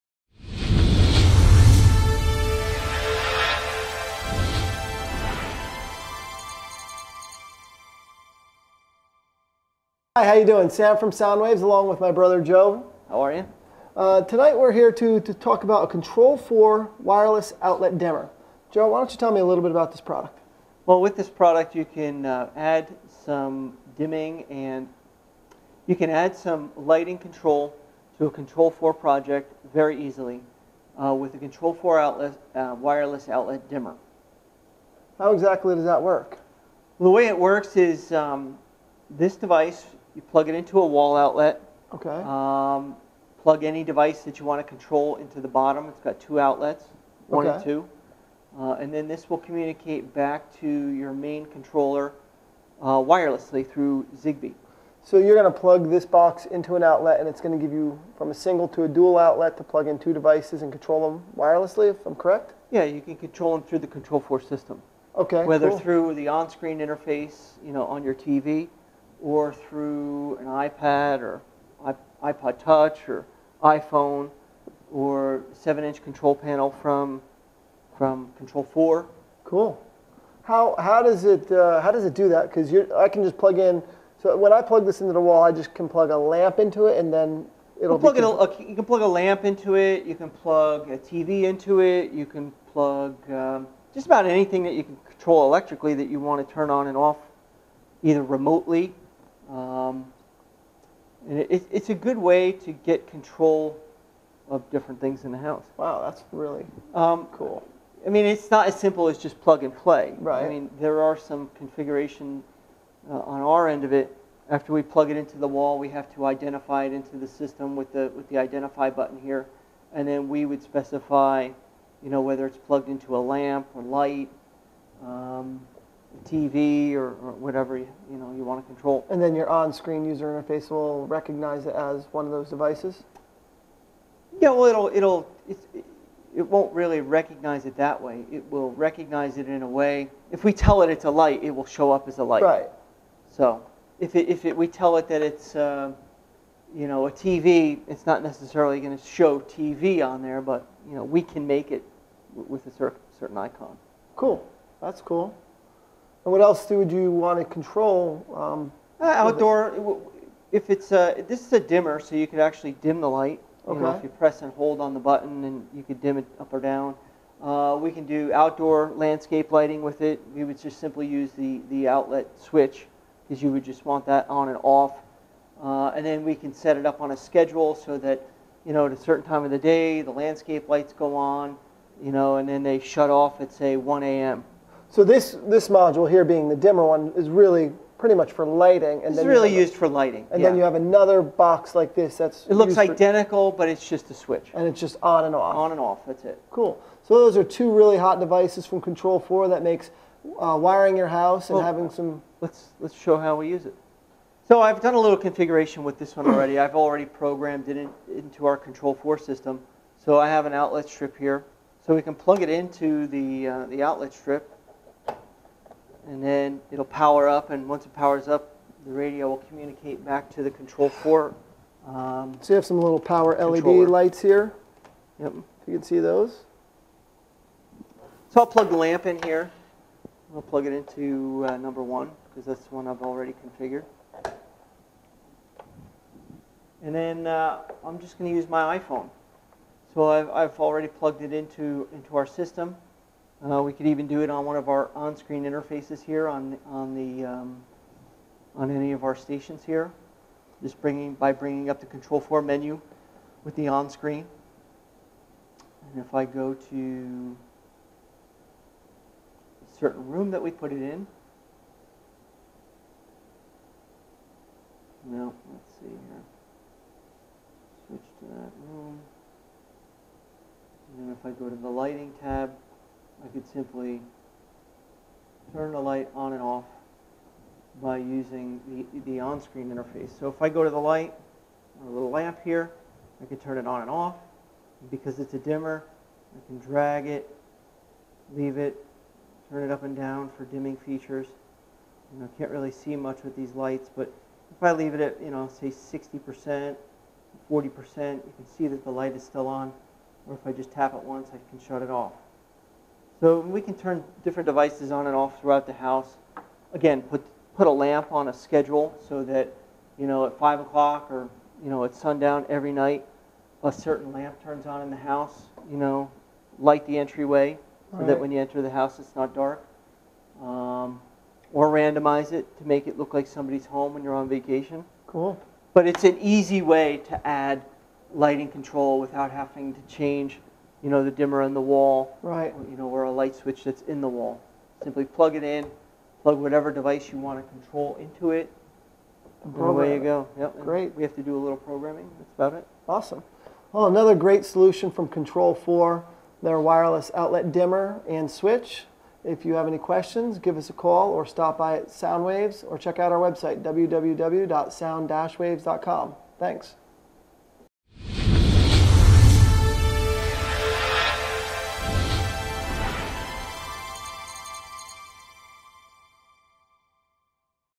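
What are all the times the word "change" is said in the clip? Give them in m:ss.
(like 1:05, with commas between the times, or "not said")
5:29.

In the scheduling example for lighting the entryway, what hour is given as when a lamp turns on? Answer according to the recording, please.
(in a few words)
5 o'clock.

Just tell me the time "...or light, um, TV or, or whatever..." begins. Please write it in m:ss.
2:03.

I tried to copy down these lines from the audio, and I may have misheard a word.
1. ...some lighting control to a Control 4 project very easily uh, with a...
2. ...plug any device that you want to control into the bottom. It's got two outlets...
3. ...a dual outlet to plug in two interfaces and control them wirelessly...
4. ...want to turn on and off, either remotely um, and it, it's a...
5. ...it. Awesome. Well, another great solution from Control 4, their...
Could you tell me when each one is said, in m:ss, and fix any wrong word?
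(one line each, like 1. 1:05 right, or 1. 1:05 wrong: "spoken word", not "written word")
1. 0:26 right
2. 0:43 right
3. 0:58 wrong: "devices", not "interfaces"
4. 1:36 right
5. 5:42 right.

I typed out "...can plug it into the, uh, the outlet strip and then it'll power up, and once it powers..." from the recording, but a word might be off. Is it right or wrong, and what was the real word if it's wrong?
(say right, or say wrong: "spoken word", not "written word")
right.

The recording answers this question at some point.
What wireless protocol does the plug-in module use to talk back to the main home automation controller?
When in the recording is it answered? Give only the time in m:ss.
0:54.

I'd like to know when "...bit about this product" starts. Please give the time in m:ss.
0:19.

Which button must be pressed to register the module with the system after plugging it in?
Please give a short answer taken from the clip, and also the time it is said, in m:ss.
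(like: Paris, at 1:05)
identify button, at 1:58.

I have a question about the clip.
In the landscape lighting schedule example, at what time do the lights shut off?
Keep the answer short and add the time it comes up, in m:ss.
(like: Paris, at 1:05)
1 a.m., at 3:03.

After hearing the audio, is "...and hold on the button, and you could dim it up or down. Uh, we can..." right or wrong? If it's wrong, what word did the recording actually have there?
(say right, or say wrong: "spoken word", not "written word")
right.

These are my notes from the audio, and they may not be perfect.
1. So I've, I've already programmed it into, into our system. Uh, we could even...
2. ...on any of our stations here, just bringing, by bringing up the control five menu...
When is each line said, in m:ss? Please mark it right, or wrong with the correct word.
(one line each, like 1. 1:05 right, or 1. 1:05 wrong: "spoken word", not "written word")
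1. 3:59 wrong: "plugged", not "programmed"
2. 4:08 wrong: "four", not "five".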